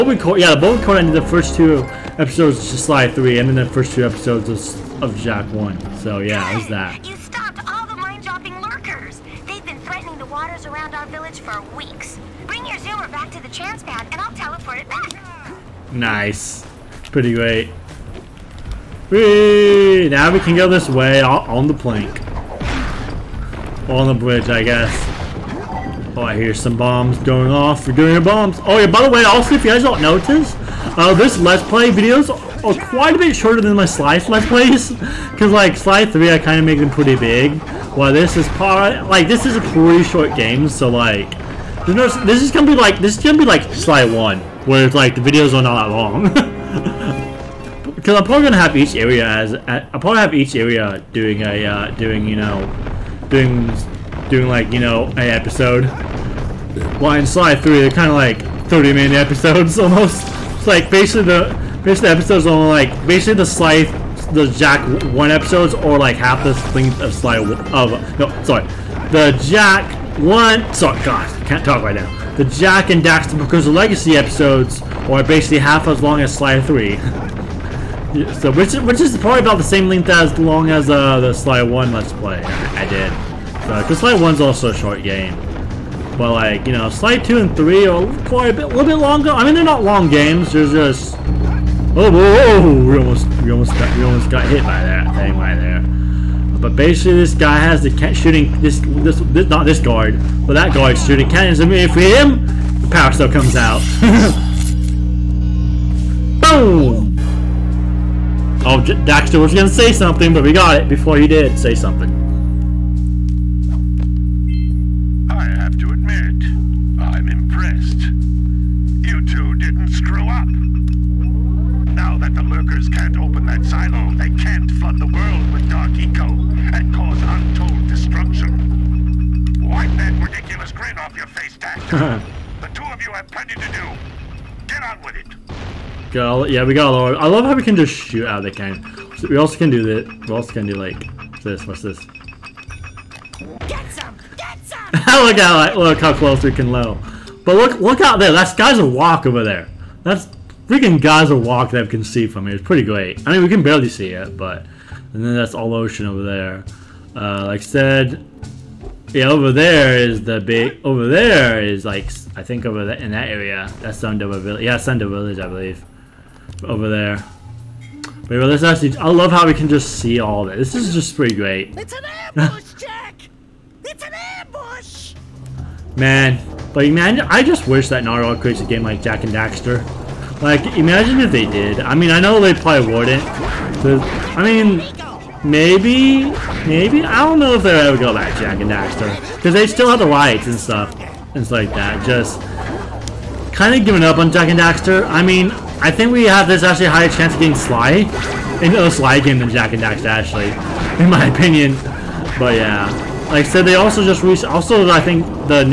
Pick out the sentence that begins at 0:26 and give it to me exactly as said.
Oh, I hear some bombs going off.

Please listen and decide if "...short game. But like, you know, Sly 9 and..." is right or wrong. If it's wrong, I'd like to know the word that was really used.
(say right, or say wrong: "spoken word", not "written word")
wrong: "2", not "9".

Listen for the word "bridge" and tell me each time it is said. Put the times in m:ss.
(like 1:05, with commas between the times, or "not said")
0:24.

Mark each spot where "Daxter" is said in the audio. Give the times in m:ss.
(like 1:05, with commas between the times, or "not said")
1:13, 1:48, 2:11, 2:59, 3:08, 3:14.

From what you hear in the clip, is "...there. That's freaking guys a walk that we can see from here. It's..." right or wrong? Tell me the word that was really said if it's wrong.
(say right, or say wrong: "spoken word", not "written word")
right.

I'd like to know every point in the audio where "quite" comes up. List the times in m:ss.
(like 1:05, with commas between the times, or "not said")
0:32, 1:28.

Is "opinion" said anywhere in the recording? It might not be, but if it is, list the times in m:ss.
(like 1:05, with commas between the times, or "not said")
3:21.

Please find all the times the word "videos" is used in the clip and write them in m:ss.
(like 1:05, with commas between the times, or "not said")
0:31, 0:45.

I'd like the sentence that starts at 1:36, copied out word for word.
But basically, this guy has the shooting this, this, this not this guard, but that guard shooting cannons.